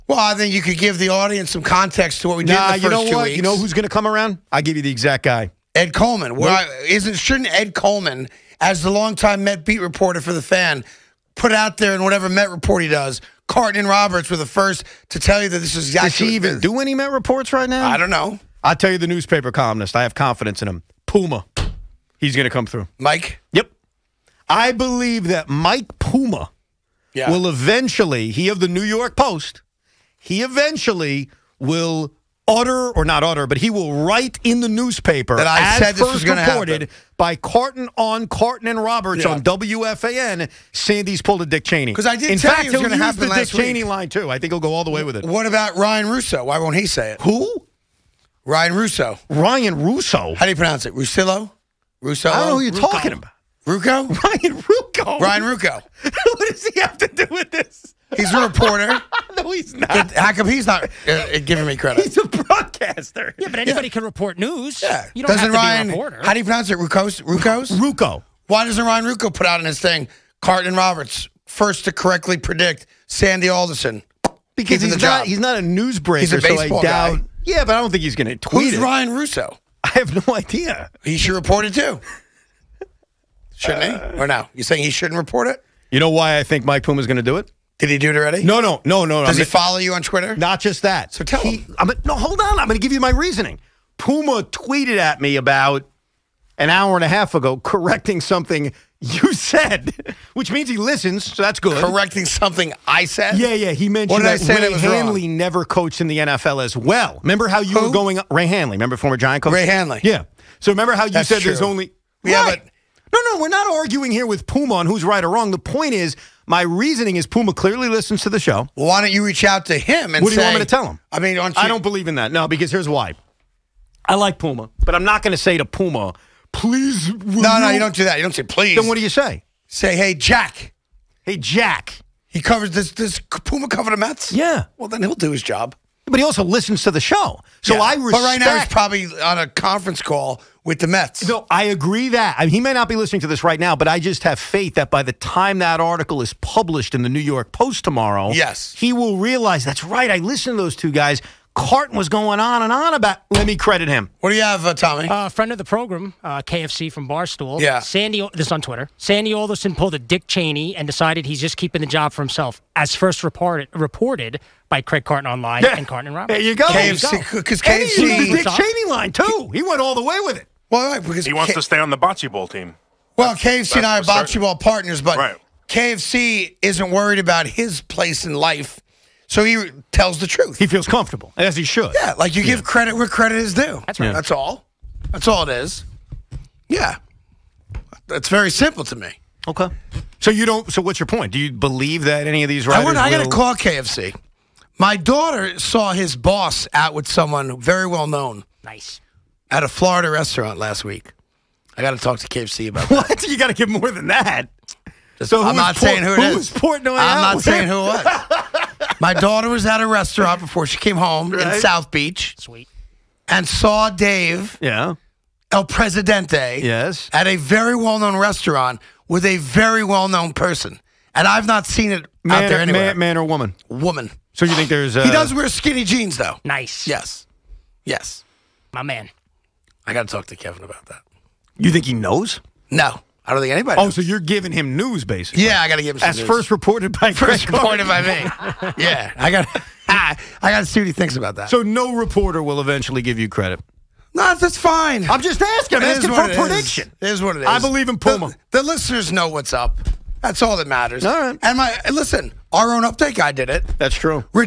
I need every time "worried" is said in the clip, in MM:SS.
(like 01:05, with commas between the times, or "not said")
02:56.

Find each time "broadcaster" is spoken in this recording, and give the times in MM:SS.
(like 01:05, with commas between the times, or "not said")
01:02.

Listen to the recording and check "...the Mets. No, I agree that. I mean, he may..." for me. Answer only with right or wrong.
right.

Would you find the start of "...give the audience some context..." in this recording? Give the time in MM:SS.
00:00.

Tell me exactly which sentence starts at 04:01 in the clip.
So no reporter will eventually give you credit.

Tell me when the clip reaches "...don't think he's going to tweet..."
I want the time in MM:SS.
01:17.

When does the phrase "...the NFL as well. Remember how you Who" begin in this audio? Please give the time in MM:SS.
01:46.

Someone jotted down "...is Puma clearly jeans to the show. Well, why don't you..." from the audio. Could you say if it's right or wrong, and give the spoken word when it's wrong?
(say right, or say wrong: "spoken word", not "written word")
wrong: "listens", not "jeans".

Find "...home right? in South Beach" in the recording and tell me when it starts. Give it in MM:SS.
03:30.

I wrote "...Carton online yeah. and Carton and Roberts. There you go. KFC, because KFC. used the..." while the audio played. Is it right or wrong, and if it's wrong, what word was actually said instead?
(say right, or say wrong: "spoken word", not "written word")
right.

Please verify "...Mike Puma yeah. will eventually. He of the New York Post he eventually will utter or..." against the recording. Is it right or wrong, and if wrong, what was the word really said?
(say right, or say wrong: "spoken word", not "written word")
right.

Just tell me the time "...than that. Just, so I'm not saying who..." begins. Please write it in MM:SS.
03:23.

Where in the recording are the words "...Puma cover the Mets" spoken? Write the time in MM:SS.
02:13.